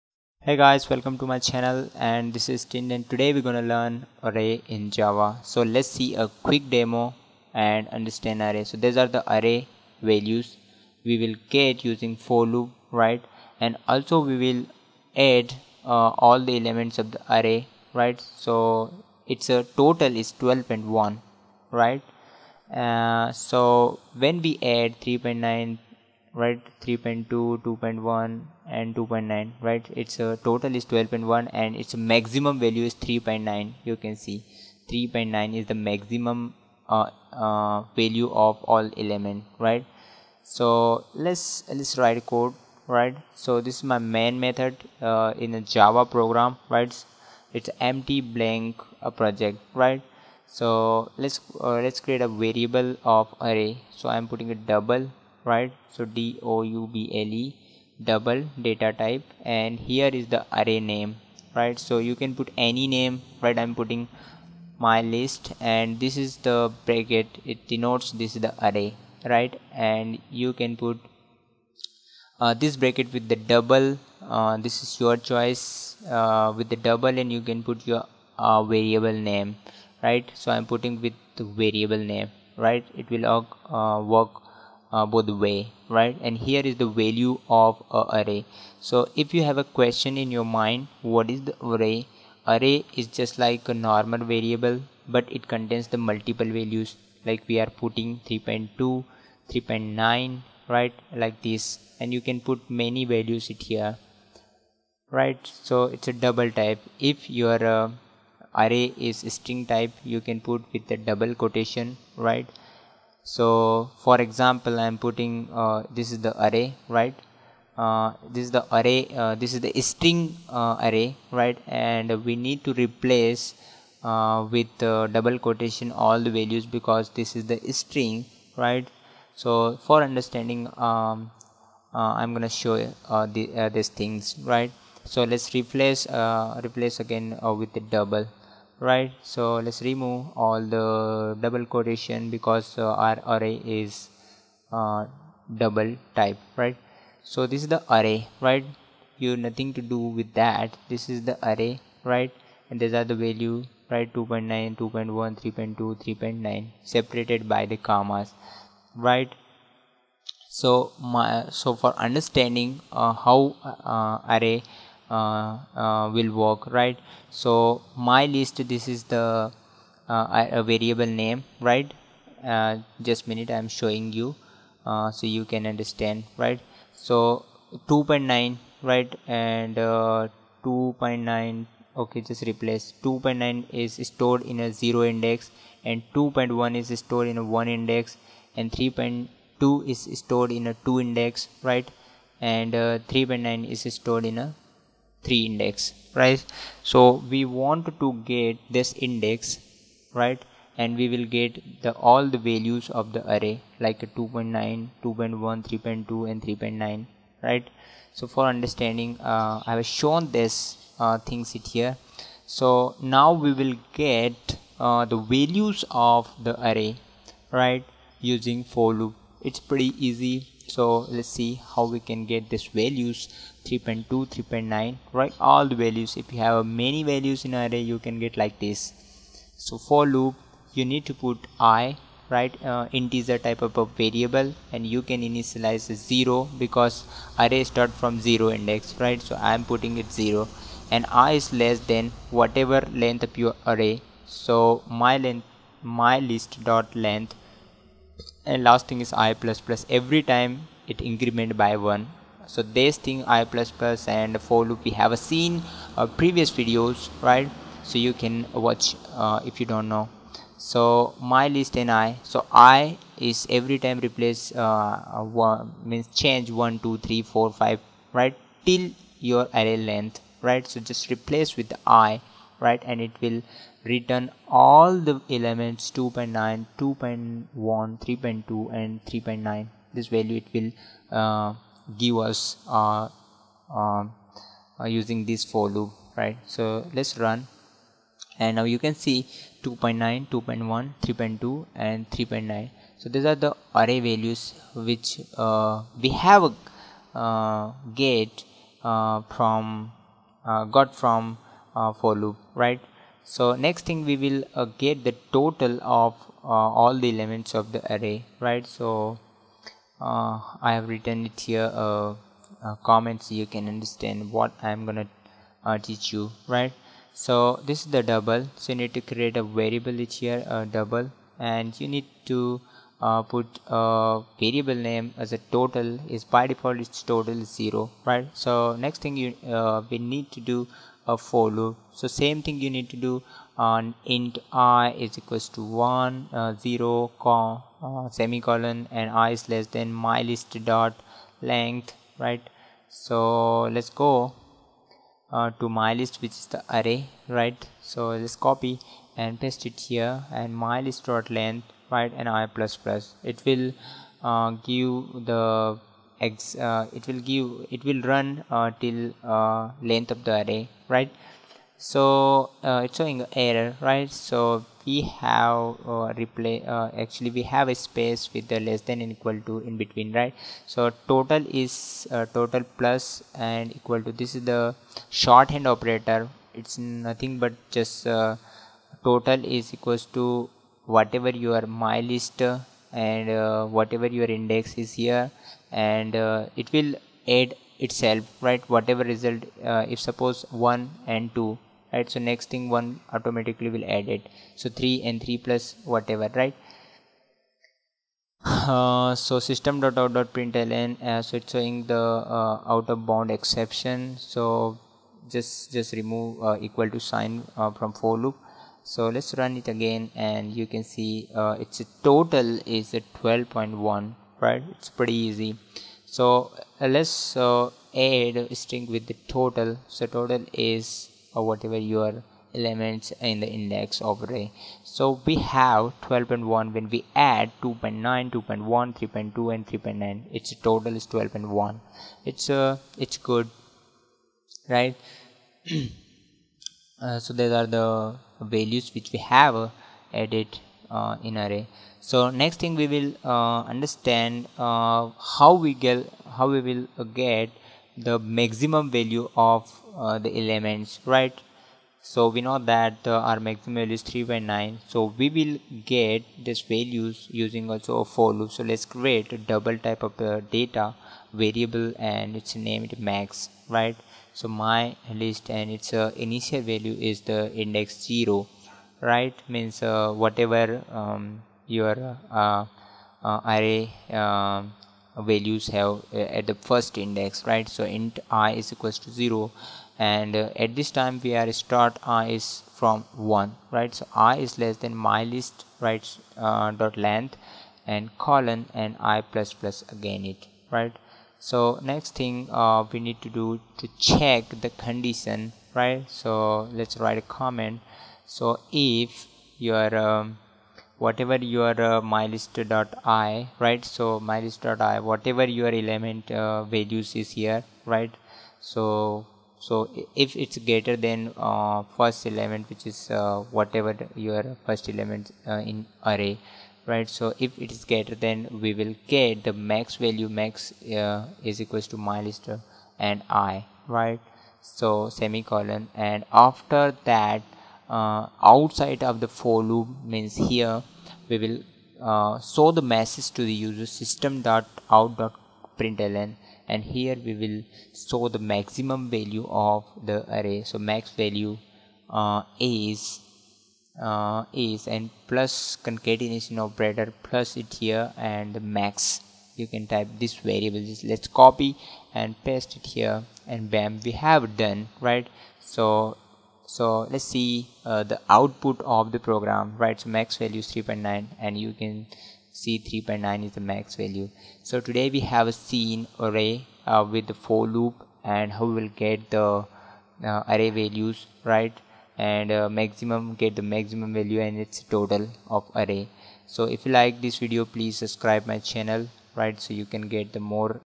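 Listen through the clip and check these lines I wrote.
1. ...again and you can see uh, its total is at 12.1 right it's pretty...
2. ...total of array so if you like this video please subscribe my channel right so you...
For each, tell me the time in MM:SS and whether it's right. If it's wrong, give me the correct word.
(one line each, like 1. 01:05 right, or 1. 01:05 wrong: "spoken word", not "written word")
1. 06:49 right
2. 09:34 right.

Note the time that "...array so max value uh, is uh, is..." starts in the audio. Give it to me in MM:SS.
09:00.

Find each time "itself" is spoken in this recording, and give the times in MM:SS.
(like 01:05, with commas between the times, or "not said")
06:27.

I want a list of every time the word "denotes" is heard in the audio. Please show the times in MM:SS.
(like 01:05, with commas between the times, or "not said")
01:07.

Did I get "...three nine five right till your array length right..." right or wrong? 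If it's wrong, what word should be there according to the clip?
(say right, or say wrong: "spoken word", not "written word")
wrong: "four", not "nine".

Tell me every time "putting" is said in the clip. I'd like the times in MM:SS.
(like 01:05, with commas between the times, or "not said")
00:54, 01:03, 01:20, 01:37, 01:54, 03:59.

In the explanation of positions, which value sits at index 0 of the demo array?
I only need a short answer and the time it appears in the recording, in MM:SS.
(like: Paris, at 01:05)
2.9, at 03:03.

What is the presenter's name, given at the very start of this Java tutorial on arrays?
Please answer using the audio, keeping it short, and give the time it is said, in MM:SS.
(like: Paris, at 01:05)
Tin, at 00:02.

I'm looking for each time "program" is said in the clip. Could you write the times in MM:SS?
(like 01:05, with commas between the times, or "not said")
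00:46, 09:19.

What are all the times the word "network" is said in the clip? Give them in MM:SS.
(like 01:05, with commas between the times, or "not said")
not said.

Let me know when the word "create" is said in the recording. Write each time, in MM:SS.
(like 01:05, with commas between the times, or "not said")
00:51, 05:19, 07:38.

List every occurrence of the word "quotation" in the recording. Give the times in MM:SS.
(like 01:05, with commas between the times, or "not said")
01:51, 02:05, 02:21.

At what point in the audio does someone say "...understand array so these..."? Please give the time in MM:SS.
00:07.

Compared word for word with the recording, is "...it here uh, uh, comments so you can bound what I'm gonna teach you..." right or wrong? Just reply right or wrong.
wrong.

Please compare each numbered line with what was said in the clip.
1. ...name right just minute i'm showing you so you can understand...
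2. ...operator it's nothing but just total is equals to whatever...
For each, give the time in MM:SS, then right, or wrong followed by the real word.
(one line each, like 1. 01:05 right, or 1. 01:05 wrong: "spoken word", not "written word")
1. 02:51 right
2. 06:15 right.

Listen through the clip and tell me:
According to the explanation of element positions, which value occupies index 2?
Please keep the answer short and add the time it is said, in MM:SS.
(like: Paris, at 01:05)
3.2, at 03:08.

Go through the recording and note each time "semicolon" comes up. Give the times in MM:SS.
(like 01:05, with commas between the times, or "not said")
05:38, 08:45.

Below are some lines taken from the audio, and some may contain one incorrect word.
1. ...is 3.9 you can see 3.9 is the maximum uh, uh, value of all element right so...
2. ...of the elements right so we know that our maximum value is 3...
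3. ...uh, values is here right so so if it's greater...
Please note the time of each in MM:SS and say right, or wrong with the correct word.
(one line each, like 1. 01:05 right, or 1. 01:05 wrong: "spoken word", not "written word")
1. 00:32 right
2. 07:29 right
3. 08:26 right.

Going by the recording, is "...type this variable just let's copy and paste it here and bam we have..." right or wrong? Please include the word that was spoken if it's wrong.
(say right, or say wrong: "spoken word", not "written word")
right.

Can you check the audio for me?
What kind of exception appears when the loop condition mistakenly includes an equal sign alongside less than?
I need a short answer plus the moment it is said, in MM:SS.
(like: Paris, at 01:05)
out of bound exception, at 06:42.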